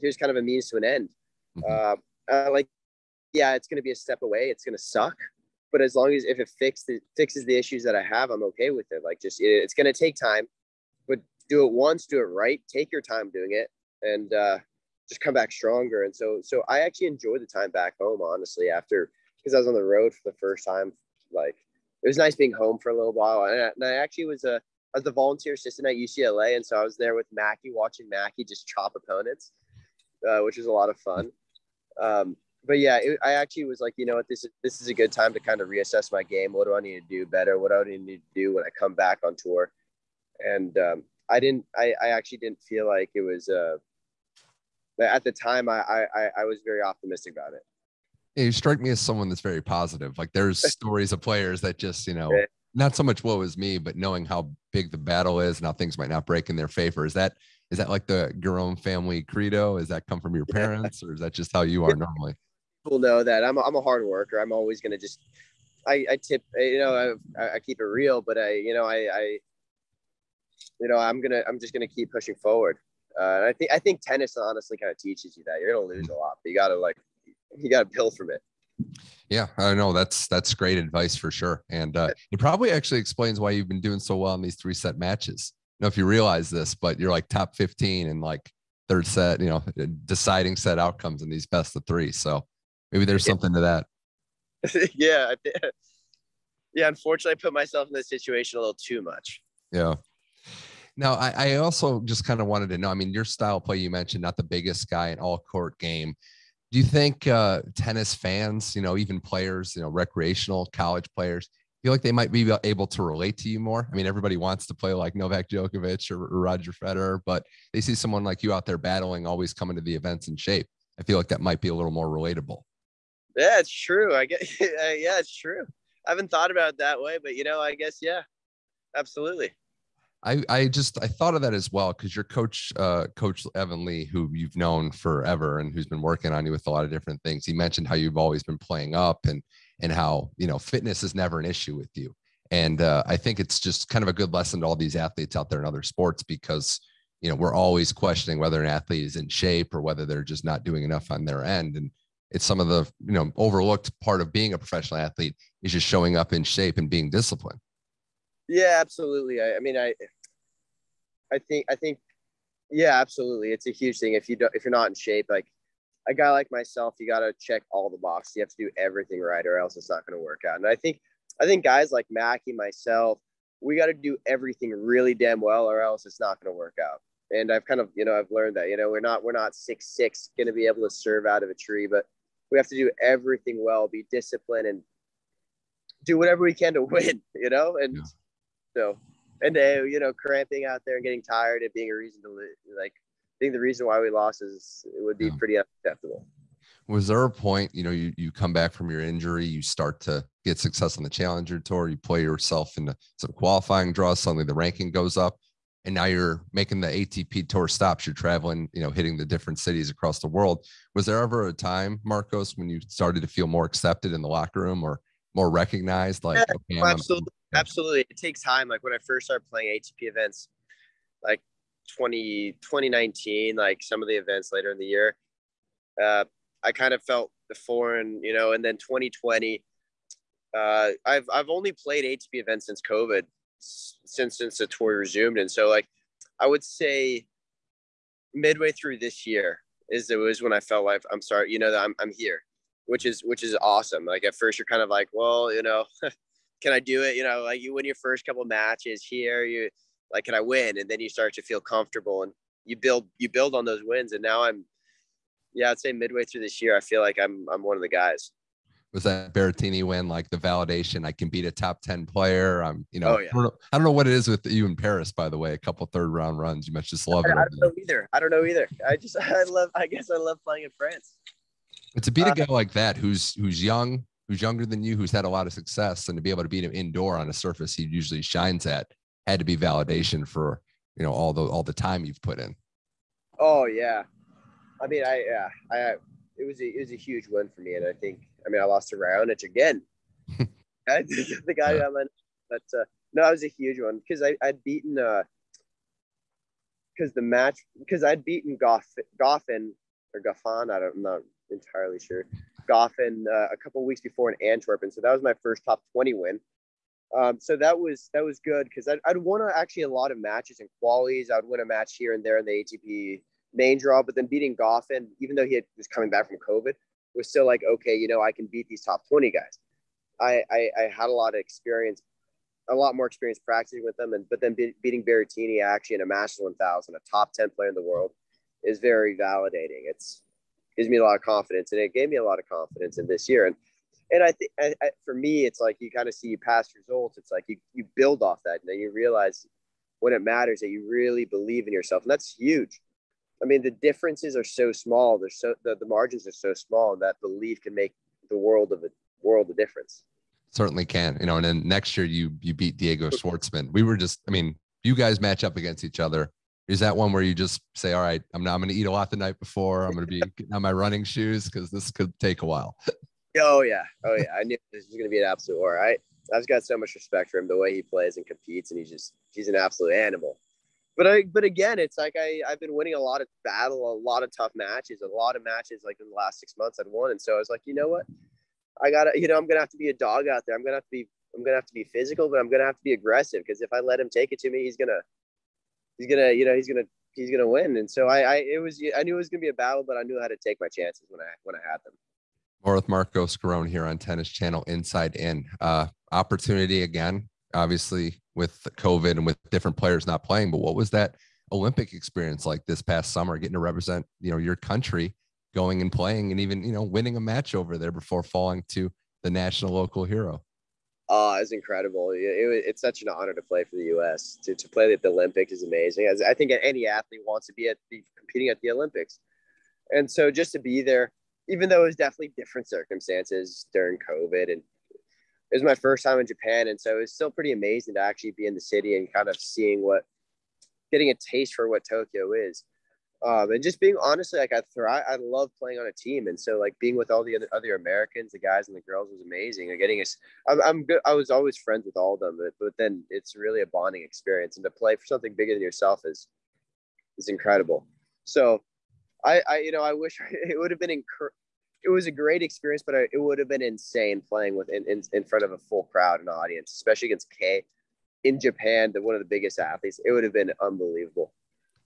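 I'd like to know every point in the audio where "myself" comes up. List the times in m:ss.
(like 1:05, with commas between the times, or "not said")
1:37, 2:46, 2:52.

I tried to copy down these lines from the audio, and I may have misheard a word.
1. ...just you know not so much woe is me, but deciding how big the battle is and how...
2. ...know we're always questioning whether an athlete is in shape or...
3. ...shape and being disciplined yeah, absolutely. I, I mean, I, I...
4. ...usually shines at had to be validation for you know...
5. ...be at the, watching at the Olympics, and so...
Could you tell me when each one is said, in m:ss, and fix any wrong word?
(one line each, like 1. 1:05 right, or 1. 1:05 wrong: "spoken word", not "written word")
1. 0:51 wrong: "knowing", not "deciding"
2. 2:27 right
3. 2:36 right
4. 4:37 right
5. 6:57 wrong: "competing", not "watching".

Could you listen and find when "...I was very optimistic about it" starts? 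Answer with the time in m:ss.
0:46.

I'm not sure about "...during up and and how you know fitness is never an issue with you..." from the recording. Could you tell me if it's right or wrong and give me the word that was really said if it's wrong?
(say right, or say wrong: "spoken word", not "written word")
wrong: "playing", not "during".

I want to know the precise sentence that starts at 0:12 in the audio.
Take your time doing it, and uh, just come back stronger.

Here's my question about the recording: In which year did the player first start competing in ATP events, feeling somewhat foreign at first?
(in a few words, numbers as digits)
2019.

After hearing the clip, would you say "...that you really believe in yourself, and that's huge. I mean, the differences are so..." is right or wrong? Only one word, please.
right.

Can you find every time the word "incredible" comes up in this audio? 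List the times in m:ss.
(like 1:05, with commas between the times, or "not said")
6:51, 7:27.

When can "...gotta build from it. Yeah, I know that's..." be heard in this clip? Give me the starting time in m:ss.
1:17.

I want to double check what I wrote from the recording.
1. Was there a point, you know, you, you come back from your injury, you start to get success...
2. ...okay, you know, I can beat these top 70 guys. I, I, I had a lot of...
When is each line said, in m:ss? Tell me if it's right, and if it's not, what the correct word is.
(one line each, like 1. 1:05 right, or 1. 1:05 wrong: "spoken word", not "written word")
1. 3:16 right
2. 5:17 wrong: "20", not "70".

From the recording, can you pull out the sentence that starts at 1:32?
So maybe there's something to that.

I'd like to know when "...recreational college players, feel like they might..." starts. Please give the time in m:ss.
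1:49.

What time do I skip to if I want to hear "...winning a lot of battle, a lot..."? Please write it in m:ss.
6:12.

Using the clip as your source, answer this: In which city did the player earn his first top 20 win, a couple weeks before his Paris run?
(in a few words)
Antwerp.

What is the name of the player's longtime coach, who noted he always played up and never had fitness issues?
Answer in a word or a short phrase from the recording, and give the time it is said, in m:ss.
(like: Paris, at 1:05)
Evan Lee, at 2:13.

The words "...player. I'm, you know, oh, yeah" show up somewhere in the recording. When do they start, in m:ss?
4:22.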